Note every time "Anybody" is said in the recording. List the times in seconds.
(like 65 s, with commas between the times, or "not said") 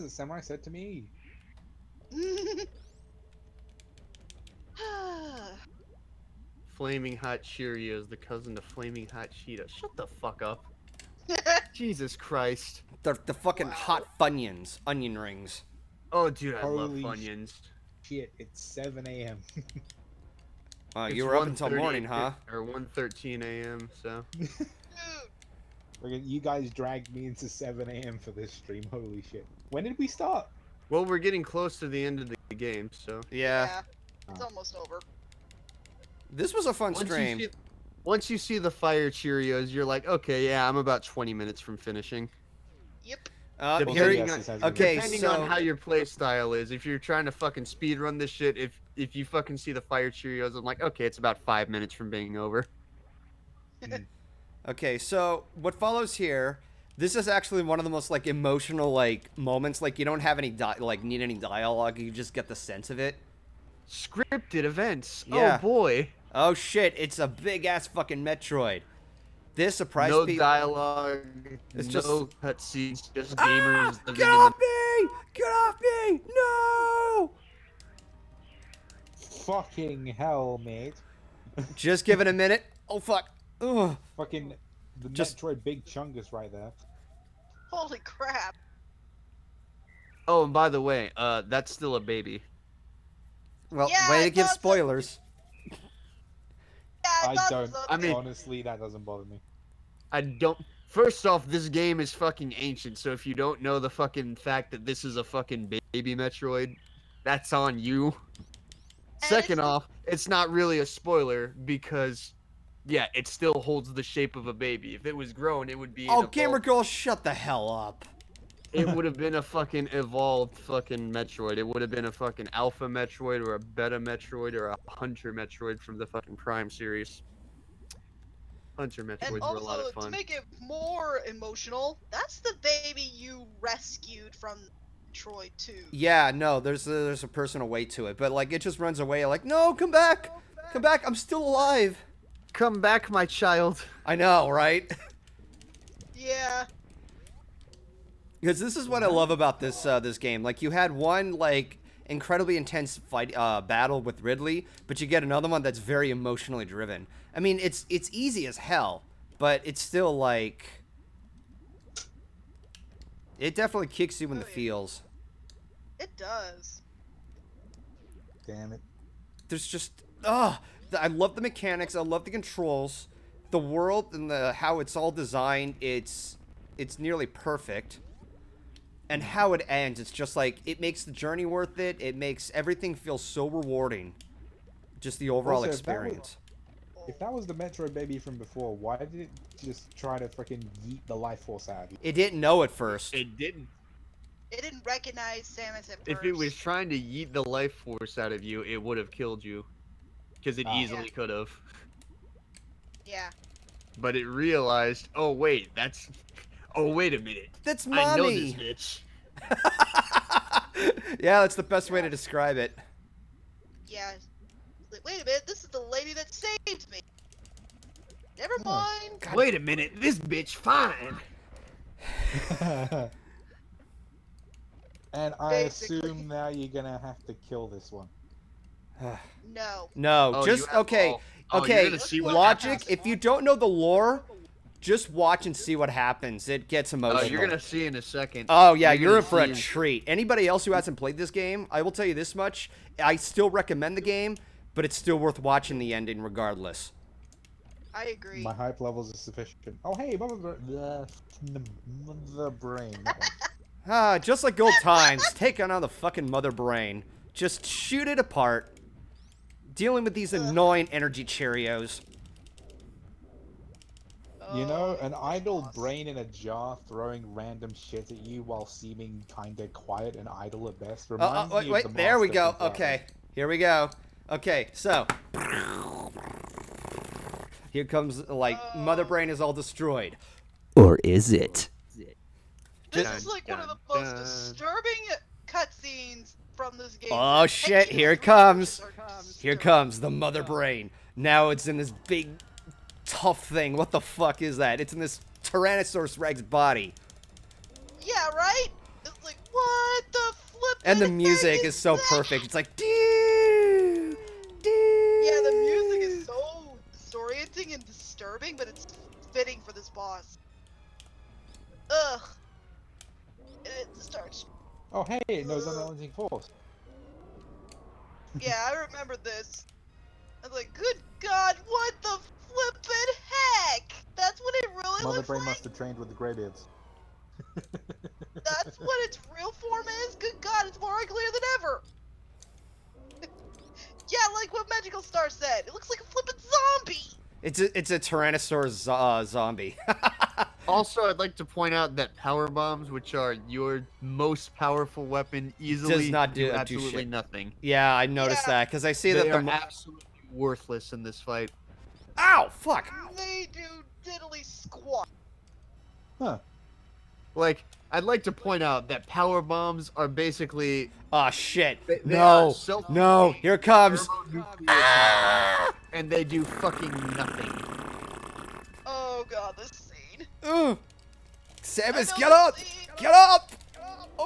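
240 s.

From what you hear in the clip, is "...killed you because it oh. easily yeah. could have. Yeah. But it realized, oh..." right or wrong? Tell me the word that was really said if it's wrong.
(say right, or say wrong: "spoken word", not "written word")
right.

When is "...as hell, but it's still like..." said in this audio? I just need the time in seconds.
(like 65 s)
158 s.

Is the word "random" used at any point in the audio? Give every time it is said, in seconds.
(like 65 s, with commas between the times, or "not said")
267 s.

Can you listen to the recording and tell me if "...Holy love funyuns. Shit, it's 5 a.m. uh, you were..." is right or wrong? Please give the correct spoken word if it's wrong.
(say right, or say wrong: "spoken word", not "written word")
wrong: "7", not "5".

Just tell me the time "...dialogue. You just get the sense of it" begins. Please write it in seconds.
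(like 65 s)
61 s.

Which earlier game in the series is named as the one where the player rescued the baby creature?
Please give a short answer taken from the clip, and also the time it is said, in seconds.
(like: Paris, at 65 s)
Metroid 2, at 135 s.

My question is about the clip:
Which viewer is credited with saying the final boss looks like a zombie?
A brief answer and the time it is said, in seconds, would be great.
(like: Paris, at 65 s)
Magical Star, at 334 s.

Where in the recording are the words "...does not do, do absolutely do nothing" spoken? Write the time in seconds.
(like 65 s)
345 s.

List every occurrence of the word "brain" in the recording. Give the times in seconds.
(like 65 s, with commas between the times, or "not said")
252 s, 256 s, 265 s, 279 s, 290 s, 325 s.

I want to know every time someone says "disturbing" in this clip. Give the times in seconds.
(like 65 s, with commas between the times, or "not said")
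284 s, 307 s.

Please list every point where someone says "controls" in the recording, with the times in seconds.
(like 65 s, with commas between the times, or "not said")
172 s.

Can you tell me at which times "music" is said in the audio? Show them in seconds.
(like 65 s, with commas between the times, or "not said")
301 s, 305 s.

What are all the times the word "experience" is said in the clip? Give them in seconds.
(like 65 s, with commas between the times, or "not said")
185 s.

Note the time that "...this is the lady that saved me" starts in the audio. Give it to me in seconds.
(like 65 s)
215 s.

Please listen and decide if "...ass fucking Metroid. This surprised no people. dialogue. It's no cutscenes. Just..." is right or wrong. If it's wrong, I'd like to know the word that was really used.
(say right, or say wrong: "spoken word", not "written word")
right.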